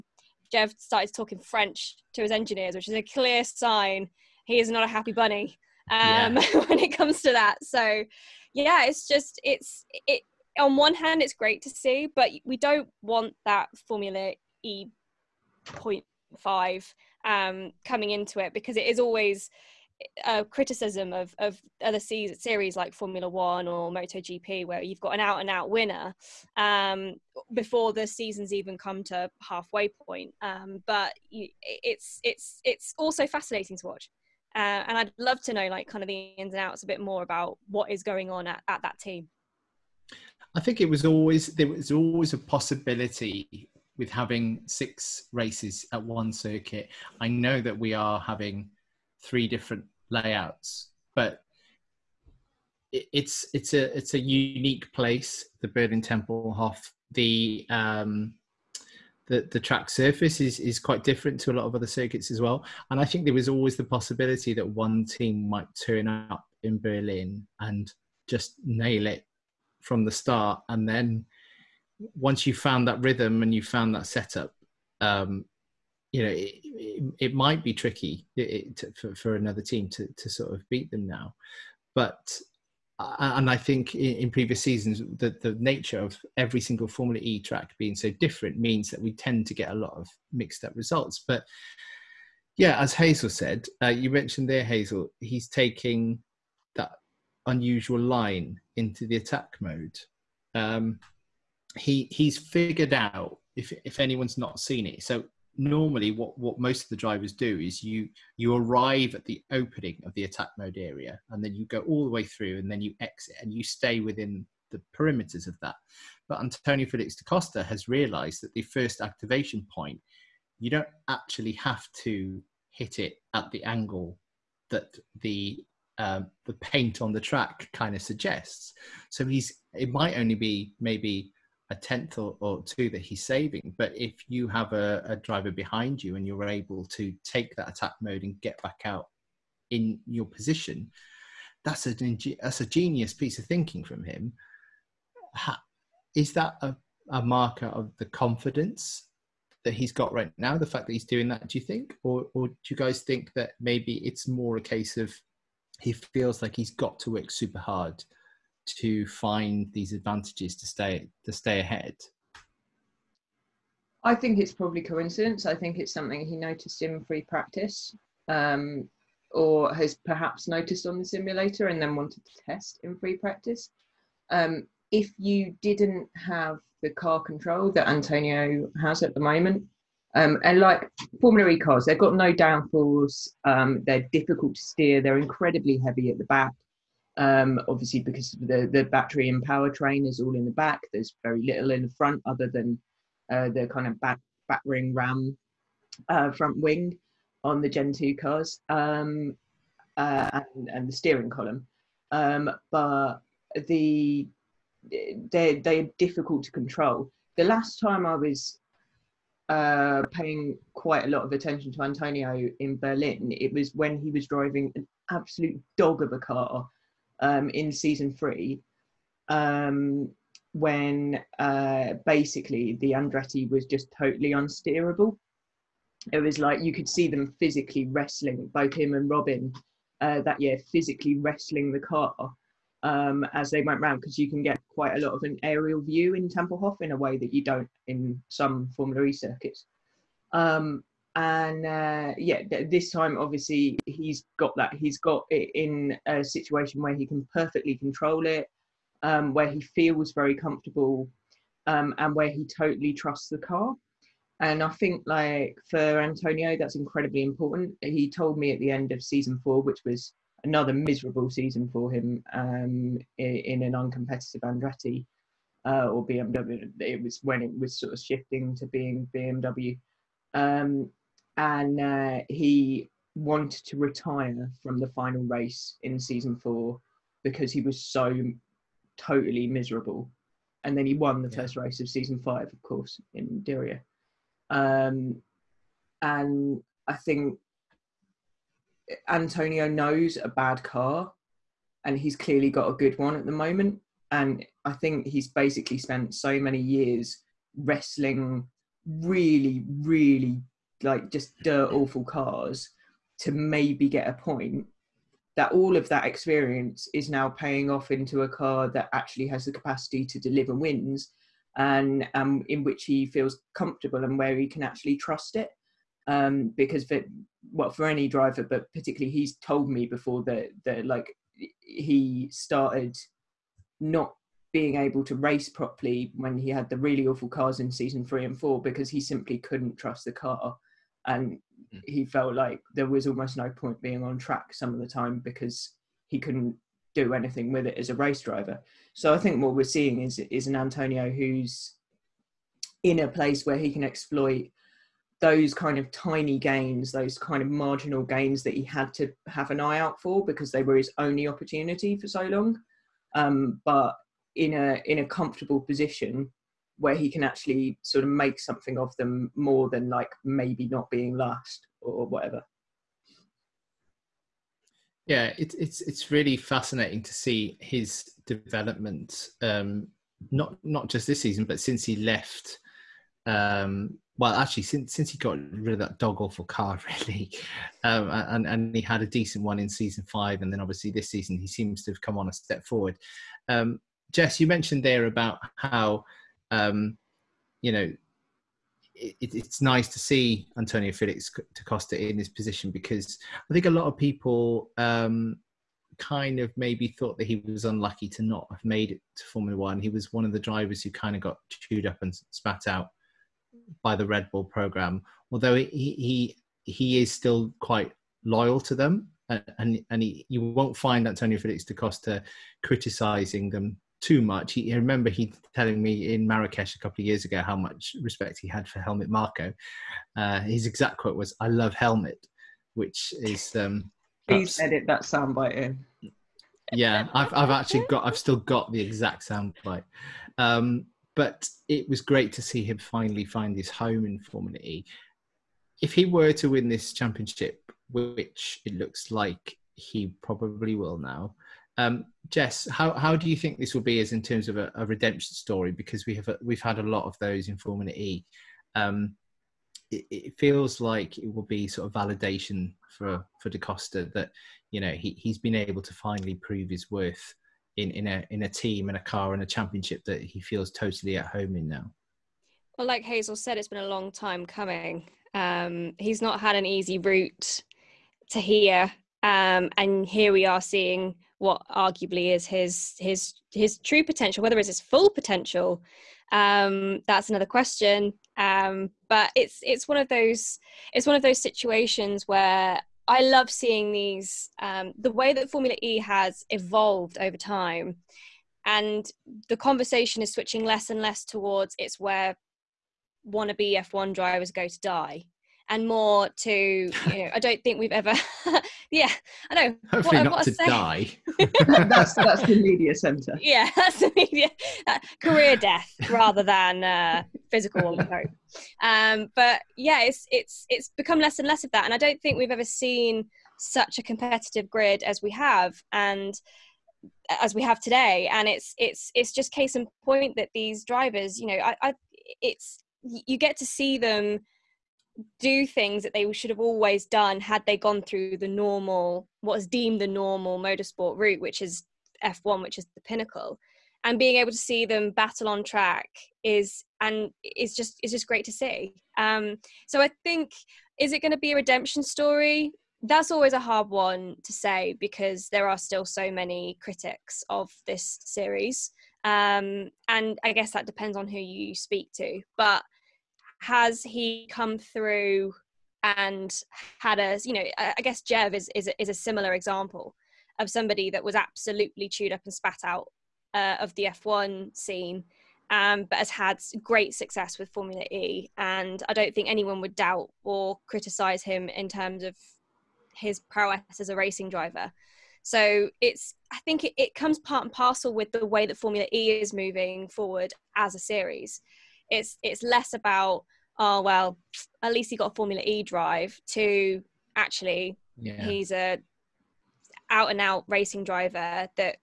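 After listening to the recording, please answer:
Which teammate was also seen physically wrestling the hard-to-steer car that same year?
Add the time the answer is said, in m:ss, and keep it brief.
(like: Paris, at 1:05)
Robin, at 3:49.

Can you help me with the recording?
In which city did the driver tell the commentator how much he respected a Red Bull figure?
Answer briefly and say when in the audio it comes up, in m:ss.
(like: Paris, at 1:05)
Marrakesh, at 6:56.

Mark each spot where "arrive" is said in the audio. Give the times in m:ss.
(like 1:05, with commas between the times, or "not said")
1:48.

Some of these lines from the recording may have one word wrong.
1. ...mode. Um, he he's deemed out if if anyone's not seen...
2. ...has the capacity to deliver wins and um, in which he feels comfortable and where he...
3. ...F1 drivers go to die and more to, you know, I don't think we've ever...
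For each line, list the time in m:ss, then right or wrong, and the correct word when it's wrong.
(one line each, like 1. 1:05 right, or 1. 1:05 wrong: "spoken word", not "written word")
1. 1:39 wrong: "figured", not "deemed"
2. 5:09 right
3. 8:13 right.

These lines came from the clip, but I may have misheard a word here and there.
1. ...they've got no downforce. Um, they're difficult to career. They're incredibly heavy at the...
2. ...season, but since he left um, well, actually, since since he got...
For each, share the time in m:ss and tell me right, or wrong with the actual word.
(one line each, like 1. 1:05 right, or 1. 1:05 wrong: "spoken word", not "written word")
1. 3:01 wrong: "steer", not "career"
2. 6:11 right.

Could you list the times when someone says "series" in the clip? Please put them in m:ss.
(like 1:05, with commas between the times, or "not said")
0:21, 9:08, 9:40.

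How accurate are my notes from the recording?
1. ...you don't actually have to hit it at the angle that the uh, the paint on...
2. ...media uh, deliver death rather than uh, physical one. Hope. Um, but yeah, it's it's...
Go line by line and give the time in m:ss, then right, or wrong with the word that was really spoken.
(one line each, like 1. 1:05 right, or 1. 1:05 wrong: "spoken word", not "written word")
1. 2:00 right
2. 8:24 wrong: "career", not "deliver".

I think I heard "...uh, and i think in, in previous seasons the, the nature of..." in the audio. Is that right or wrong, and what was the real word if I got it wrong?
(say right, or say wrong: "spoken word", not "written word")
right.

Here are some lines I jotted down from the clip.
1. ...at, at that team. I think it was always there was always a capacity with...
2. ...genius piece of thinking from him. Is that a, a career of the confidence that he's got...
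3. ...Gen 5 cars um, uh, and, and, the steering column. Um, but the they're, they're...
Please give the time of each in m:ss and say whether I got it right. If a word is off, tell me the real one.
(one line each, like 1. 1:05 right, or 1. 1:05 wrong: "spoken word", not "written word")
1. 0:38 wrong: "possibility", not "capacity"
2. 2:22 wrong: "marker", not "career"
3. 3:17 wrong: "2", not "5".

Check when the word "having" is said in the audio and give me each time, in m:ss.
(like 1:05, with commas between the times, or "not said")
0:44, 0:48.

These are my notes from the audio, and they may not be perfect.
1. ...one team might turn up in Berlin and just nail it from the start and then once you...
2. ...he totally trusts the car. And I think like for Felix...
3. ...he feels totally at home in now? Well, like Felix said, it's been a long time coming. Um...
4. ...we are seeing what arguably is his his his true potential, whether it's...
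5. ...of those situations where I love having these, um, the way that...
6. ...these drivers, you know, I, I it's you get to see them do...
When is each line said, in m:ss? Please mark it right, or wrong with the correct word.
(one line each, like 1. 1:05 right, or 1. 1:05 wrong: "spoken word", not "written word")
1. 1:04 right
2. 4:12 wrong: "Antonio", not "Felix"
3. 7:40 wrong: "Hazel", not "Felix"
4. 7:50 right
5. 8:01 wrong: "seeing", not "having"
6. 8:40 right.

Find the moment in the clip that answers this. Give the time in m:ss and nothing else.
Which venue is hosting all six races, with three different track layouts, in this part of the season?
0:55.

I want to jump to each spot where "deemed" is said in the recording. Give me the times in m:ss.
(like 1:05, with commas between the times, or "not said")
8:49.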